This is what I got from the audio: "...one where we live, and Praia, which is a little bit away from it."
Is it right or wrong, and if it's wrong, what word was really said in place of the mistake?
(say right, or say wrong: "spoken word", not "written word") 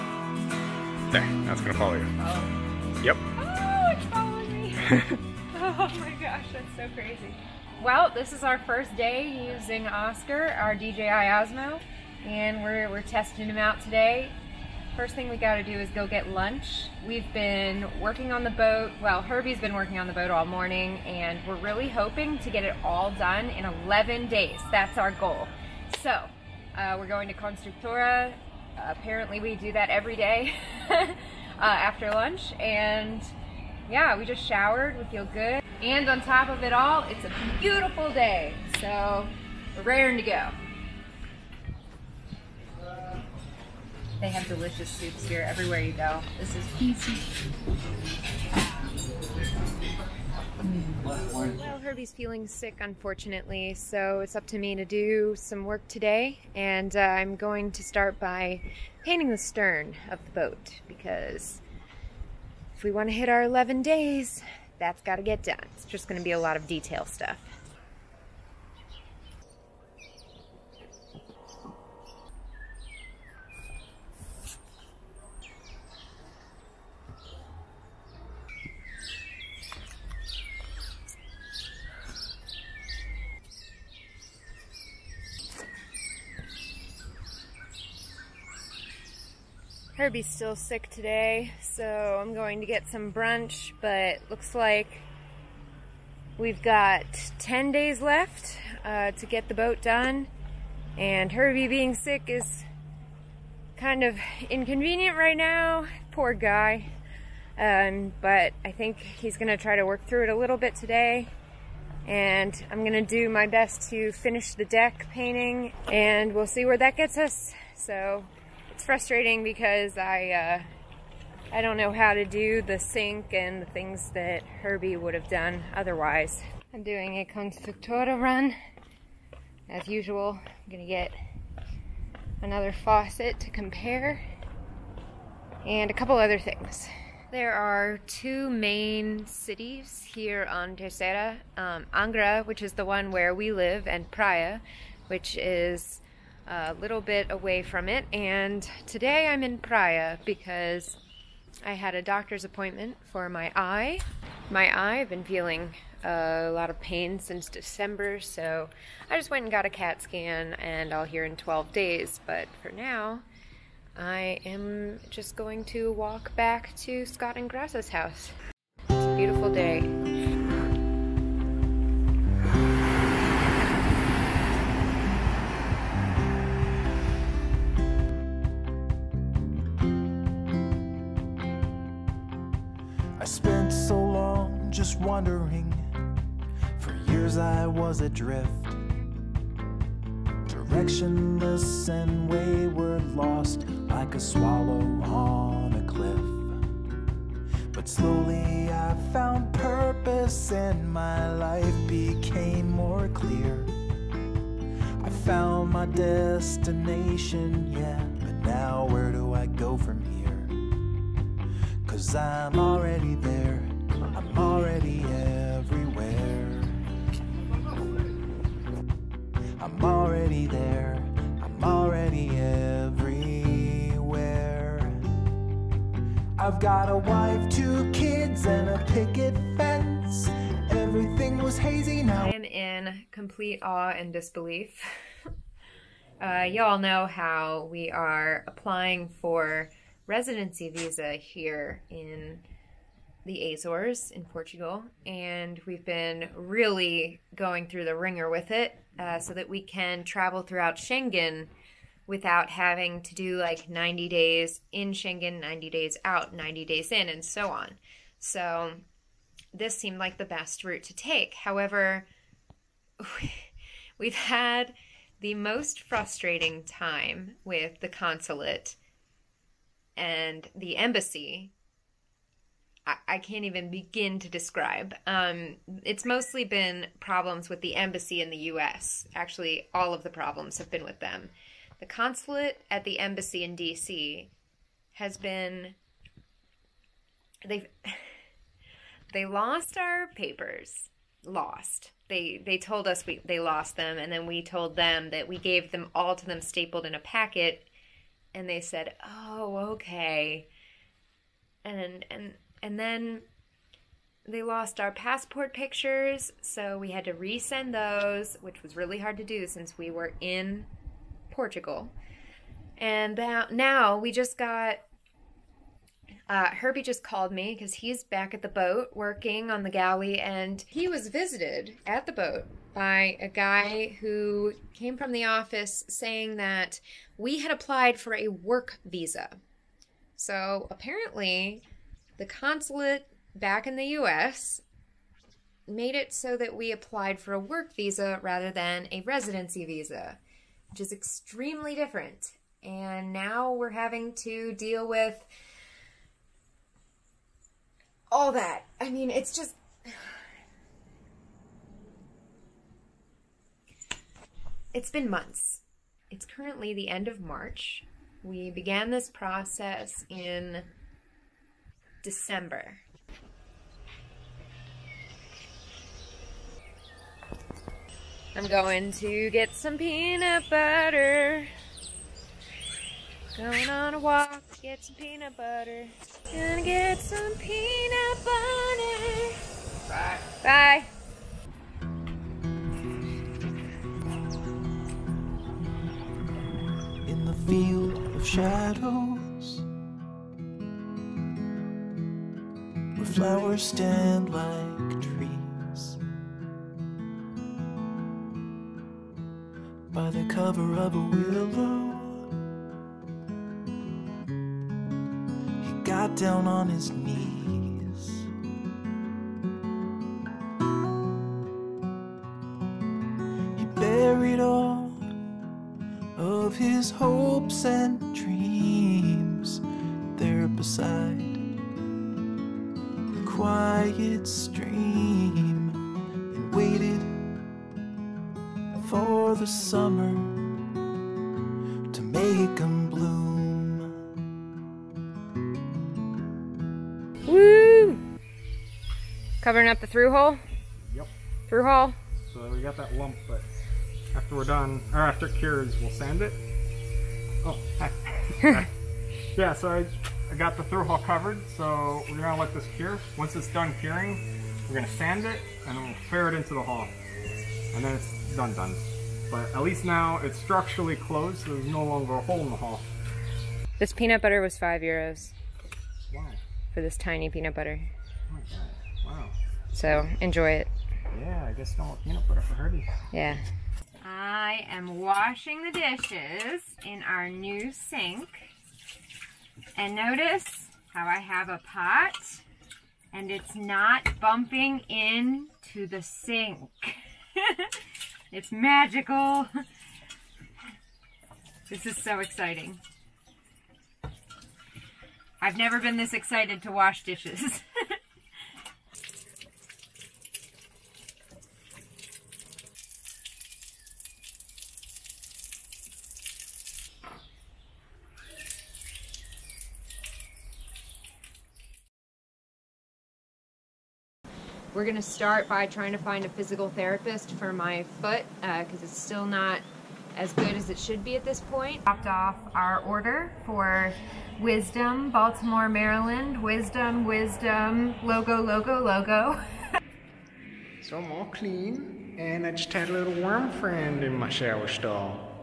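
right.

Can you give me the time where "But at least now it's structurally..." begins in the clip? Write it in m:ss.
7:39.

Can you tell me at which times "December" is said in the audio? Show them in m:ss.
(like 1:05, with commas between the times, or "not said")
2:37, 6:02.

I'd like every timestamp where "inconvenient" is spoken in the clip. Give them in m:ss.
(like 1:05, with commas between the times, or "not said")
1:44.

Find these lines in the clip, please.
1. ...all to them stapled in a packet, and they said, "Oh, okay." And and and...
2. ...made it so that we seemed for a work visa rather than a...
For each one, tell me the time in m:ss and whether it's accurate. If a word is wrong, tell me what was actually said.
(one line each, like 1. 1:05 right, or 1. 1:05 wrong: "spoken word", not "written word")
1. 4:55 right
2. 5:35 wrong: "applied", not "seemed".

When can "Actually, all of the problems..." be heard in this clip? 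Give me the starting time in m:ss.
4:39.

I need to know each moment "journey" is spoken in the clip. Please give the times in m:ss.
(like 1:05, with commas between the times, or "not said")
not said.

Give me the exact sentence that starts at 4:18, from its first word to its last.
So this seemed like the best route to take.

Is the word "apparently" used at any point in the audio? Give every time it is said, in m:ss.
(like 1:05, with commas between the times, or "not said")
0:28, 5:30.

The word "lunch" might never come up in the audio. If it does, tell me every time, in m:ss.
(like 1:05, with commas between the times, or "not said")
0:16, 0:32.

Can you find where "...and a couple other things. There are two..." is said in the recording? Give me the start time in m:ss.
2:15.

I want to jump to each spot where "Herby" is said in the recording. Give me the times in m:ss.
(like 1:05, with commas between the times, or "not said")
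0:19, 0:51, 1:30, 1:41, 2:04, 5:16, 7:52.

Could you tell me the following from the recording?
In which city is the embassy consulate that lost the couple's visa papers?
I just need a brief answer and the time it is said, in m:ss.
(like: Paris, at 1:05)
D.C., at 4:43.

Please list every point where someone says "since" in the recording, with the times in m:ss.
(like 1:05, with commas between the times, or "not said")
2:37, 5:09.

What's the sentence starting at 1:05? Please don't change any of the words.
It's just going to be a lot of detail stuff.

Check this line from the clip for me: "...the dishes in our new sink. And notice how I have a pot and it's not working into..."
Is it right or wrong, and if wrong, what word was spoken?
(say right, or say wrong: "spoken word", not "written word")
wrong: "bumping", not "working".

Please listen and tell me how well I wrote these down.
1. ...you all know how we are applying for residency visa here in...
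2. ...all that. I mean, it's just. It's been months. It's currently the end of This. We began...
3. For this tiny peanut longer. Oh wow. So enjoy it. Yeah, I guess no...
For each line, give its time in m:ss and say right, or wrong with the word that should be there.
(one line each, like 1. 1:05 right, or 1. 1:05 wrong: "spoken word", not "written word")
1. 3:56 right
2. 5:48 wrong: "March", not "This"
3. 7:46 wrong: "butter", not "longer".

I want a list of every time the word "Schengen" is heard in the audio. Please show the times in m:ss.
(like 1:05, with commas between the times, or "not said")
4:10, 4:14.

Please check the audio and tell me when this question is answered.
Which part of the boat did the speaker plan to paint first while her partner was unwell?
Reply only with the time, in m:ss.
0:59.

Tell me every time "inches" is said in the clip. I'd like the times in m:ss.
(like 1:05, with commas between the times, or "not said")
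not said.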